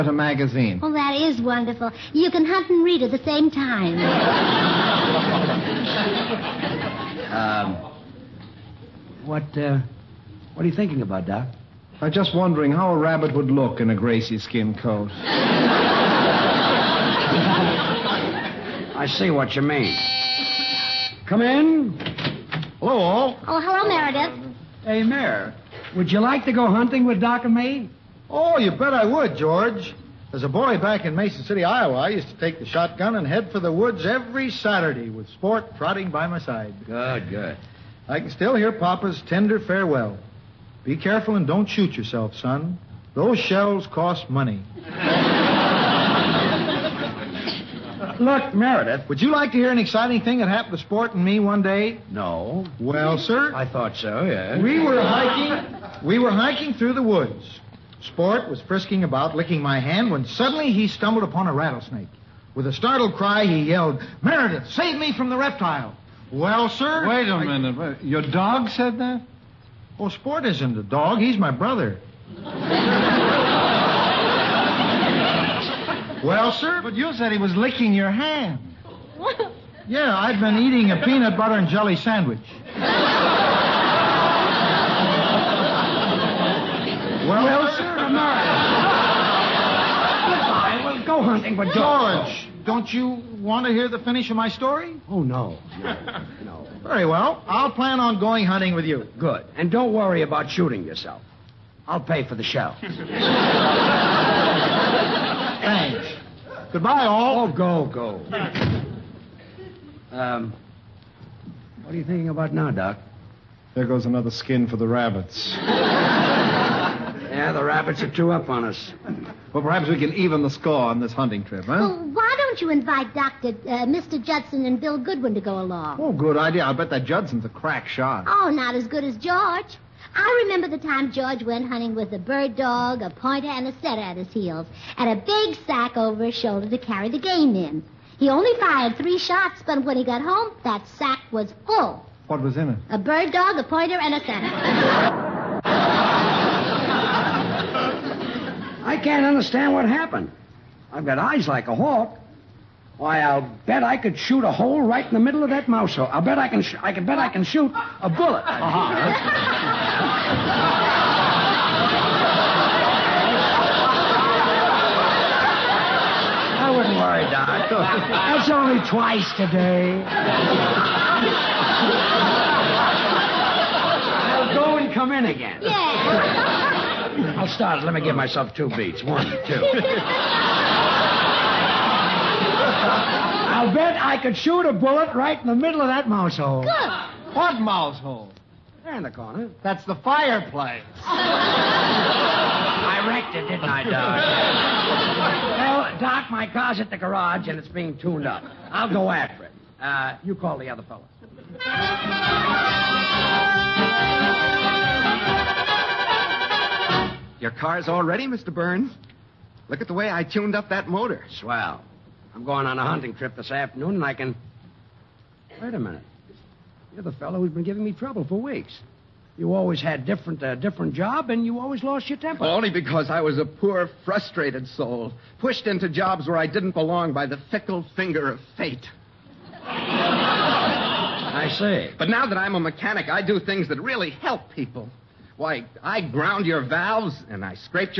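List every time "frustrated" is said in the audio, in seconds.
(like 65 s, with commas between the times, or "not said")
224 s.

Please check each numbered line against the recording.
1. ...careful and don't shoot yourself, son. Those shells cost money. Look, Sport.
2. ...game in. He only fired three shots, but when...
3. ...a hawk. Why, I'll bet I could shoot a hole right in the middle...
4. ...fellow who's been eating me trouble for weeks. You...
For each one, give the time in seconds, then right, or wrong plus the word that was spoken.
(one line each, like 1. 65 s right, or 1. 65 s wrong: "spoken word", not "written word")
1. 40 s wrong: "Meredith", not "Sport"
2. 137 s right
3. 151 s right
4. 217 s wrong: "giving", not "eating".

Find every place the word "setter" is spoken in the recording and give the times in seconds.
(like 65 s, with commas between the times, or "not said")
133 s, 144 s.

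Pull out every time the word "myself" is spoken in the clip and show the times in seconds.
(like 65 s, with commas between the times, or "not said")
178 s.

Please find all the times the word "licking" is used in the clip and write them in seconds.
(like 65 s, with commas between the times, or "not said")
59 s, 77 s.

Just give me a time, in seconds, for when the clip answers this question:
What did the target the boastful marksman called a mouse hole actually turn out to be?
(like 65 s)
189 s.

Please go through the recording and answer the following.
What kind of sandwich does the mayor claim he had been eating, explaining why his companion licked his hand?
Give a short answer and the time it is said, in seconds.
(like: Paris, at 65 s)
Peanut butter and jelly, at 80 s.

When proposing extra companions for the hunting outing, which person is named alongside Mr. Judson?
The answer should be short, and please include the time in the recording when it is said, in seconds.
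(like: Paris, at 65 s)
Bill Goodwin, at 124 s.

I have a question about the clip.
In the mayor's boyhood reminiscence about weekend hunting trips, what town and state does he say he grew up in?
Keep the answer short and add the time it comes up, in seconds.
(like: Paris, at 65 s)
Mason City, Iowa, at 31 s.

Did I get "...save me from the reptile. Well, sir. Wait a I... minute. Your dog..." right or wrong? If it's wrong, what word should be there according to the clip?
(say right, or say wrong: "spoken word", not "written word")
right.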